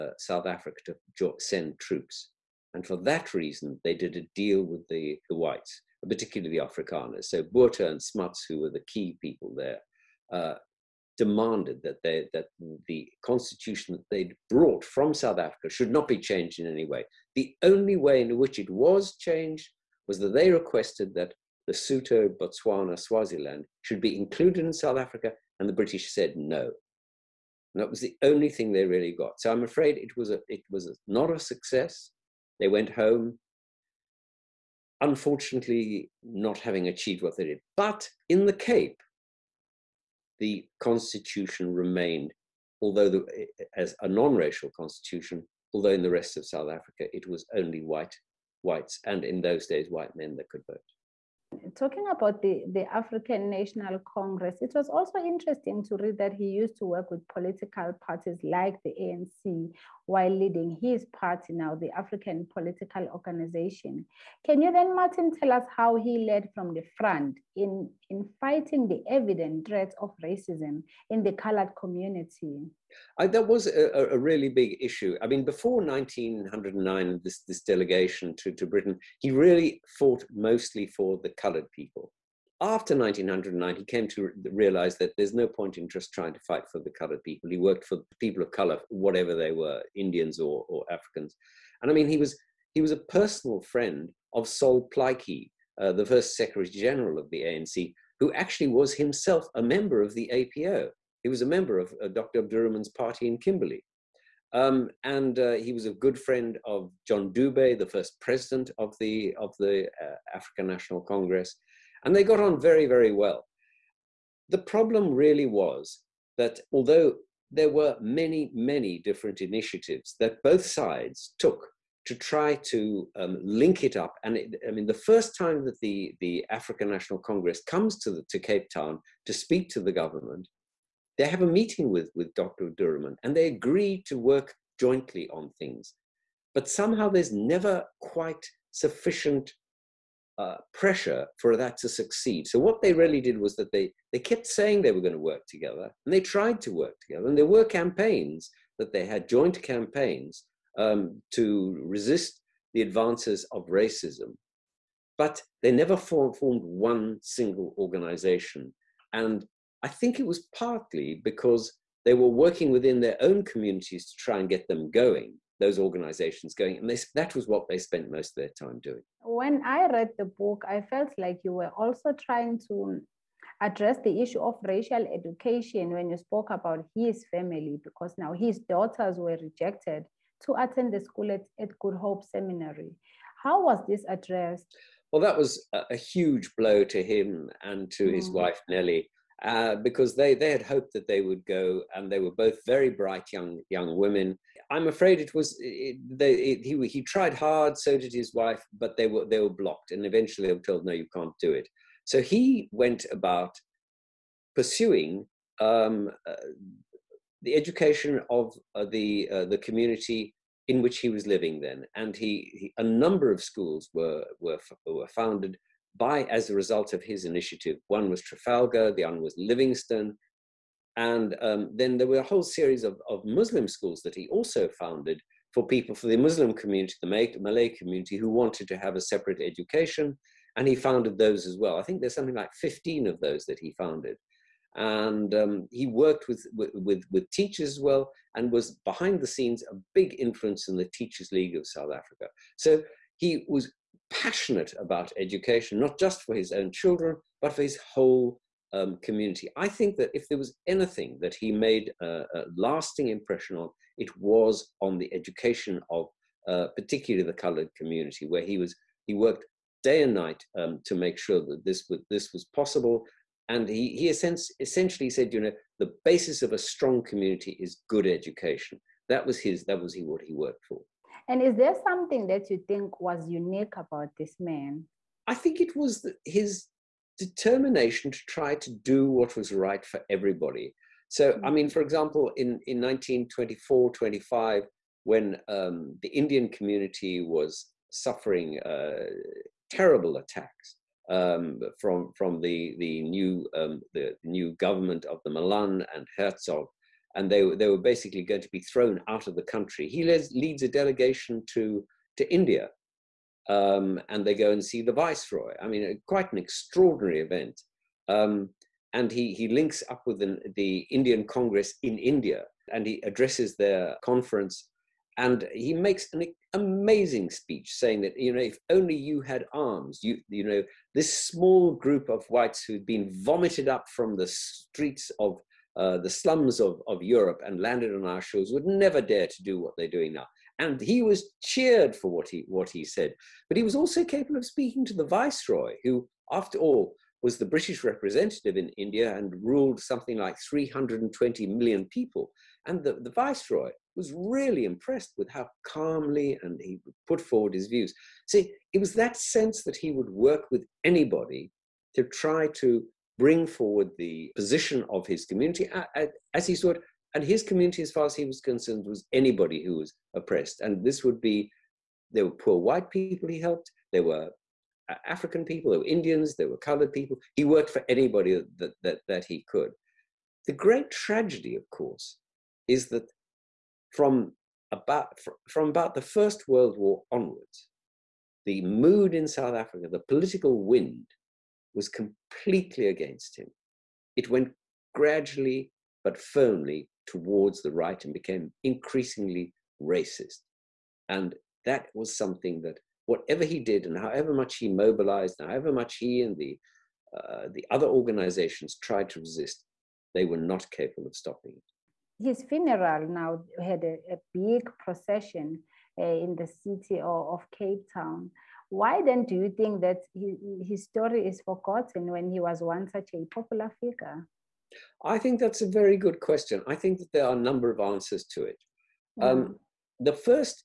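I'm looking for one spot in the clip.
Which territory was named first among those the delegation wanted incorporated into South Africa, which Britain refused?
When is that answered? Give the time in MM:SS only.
00:21.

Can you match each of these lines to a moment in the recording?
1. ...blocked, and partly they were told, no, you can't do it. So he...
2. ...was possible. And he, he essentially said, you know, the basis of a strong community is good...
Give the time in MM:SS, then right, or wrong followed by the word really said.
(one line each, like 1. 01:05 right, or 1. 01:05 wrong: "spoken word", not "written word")
1. 03:19 wrong: "eventually", not "partly"
2. 04:22 right.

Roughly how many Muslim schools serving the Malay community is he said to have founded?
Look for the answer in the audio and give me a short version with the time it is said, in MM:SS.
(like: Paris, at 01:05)
15, at 03:52.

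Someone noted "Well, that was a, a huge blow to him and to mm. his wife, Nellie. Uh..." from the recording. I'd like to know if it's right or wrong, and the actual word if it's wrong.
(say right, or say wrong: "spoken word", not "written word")
right.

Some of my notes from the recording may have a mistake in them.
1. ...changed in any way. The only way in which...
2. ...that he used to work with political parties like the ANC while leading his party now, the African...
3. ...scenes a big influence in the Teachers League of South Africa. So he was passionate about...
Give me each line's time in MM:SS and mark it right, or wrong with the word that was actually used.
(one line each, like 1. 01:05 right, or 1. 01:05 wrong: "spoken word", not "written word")
1. 00:16 right
2. 00:56 right
3. 03:59 right.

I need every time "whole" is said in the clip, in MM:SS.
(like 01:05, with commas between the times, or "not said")
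03:42, 04:07.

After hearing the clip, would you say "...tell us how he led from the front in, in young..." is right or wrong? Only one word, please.
wrong.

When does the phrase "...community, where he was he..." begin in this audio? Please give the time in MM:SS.
04:17.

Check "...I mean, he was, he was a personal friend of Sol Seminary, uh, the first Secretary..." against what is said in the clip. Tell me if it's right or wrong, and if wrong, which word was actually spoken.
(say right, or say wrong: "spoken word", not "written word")
wrong: "Plaatje", not "Seminary".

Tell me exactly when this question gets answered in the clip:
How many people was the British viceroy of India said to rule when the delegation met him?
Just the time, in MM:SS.
05:40.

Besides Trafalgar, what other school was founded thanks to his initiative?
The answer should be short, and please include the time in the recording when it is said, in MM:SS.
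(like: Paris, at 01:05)
Livingstone, at 03:39.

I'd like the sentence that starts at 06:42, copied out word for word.
His funeral now had a, a big procession uh, in the city of, of Cape Town.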